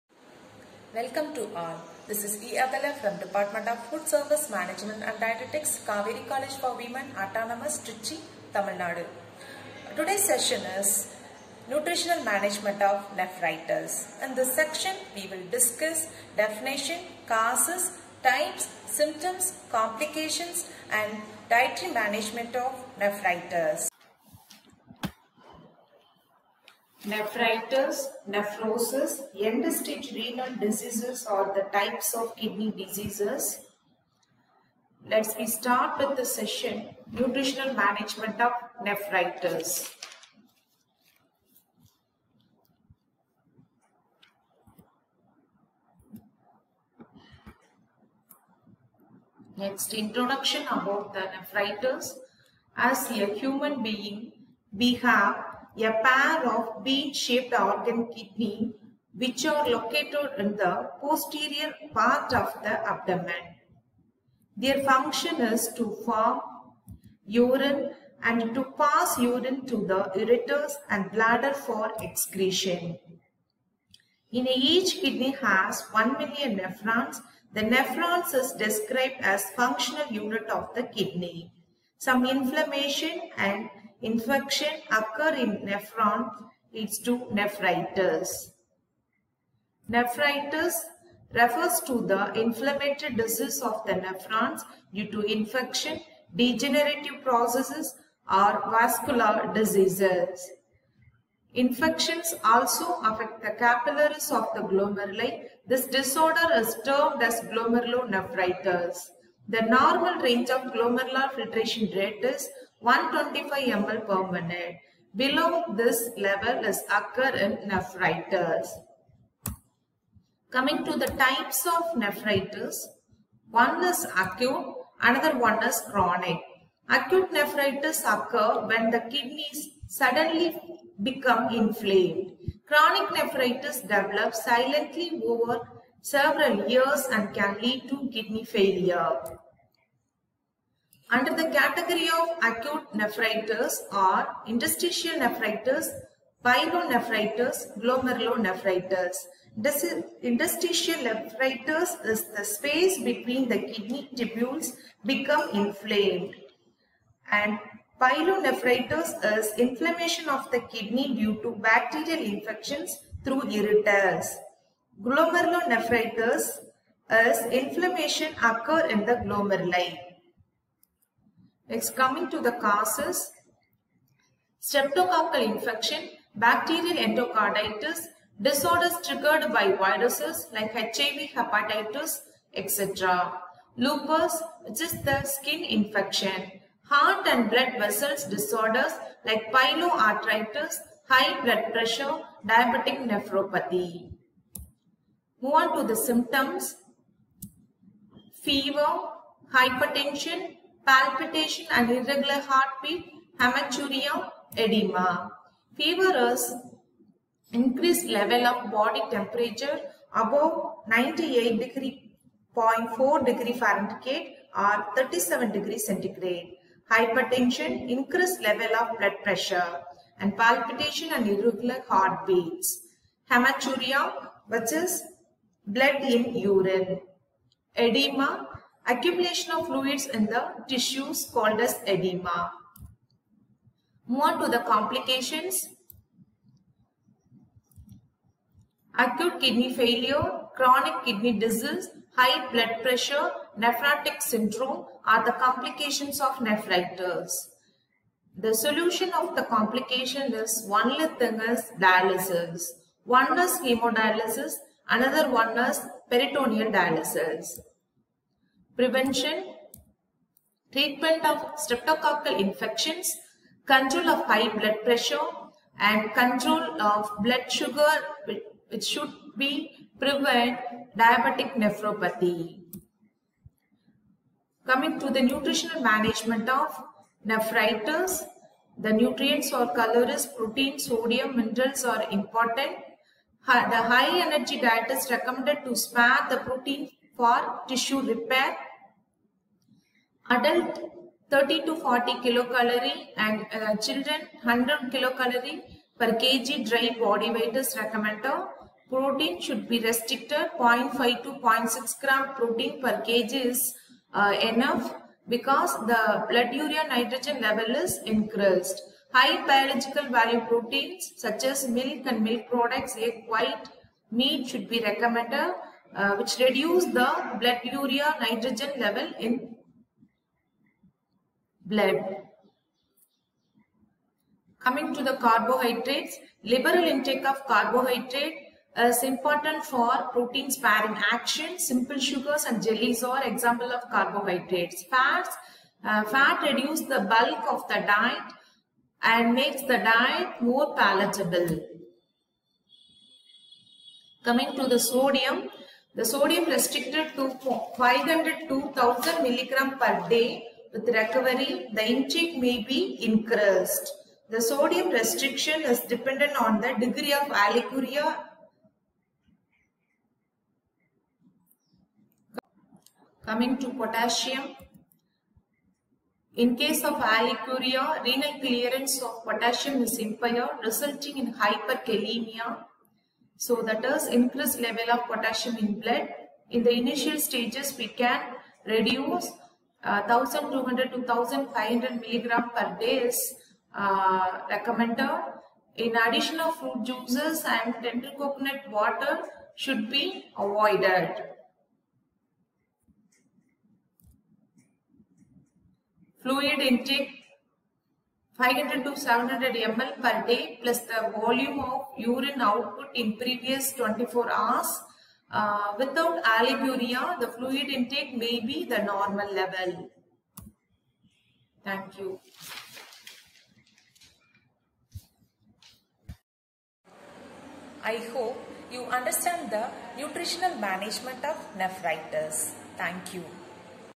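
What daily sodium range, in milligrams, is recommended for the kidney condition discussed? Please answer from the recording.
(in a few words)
500 to 1000 mg.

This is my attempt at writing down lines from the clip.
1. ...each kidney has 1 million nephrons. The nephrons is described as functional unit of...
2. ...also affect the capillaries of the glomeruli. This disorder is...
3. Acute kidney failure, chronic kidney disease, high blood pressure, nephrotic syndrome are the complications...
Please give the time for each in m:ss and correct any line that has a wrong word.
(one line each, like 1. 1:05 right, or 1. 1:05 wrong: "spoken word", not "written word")
1. 1:14 right
2. 1:42 right
3. 3:58 right.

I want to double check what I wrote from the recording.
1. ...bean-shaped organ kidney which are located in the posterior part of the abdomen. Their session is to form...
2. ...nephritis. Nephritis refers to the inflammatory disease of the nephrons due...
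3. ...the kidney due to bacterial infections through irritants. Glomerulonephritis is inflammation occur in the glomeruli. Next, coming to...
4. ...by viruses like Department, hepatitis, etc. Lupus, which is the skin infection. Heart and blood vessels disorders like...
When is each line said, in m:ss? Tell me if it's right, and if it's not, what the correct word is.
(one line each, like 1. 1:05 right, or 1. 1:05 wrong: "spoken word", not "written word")
1. 0:56 wrong: "function", not "session"
2. 1:27 right
3. 2:40 right
4. 2:59 wrong: "HIV", not "Department".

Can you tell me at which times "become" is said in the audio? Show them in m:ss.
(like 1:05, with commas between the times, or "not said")
2:11, 2:35.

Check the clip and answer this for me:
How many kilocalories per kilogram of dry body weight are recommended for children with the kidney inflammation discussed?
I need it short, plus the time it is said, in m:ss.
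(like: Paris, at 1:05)
100, at 4:54.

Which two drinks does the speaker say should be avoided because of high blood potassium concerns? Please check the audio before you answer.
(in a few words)
fruit juices and tender coconut water.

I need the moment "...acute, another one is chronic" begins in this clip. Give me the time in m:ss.
2:04.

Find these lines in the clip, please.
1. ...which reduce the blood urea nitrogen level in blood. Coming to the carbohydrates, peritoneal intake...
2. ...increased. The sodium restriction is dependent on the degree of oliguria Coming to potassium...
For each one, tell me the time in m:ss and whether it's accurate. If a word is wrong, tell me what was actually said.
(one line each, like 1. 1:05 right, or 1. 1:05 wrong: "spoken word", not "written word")
1. 5:16 wrong: "liberal", not "peritoneal"
2. 5:53 right.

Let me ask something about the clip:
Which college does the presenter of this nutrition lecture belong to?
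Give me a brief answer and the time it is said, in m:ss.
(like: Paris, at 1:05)
Cauvery College for Women, at 0:05.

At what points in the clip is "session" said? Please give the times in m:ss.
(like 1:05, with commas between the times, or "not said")
0:10, 0:36.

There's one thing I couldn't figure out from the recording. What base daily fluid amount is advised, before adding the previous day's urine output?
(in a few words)
500 to 700 ml.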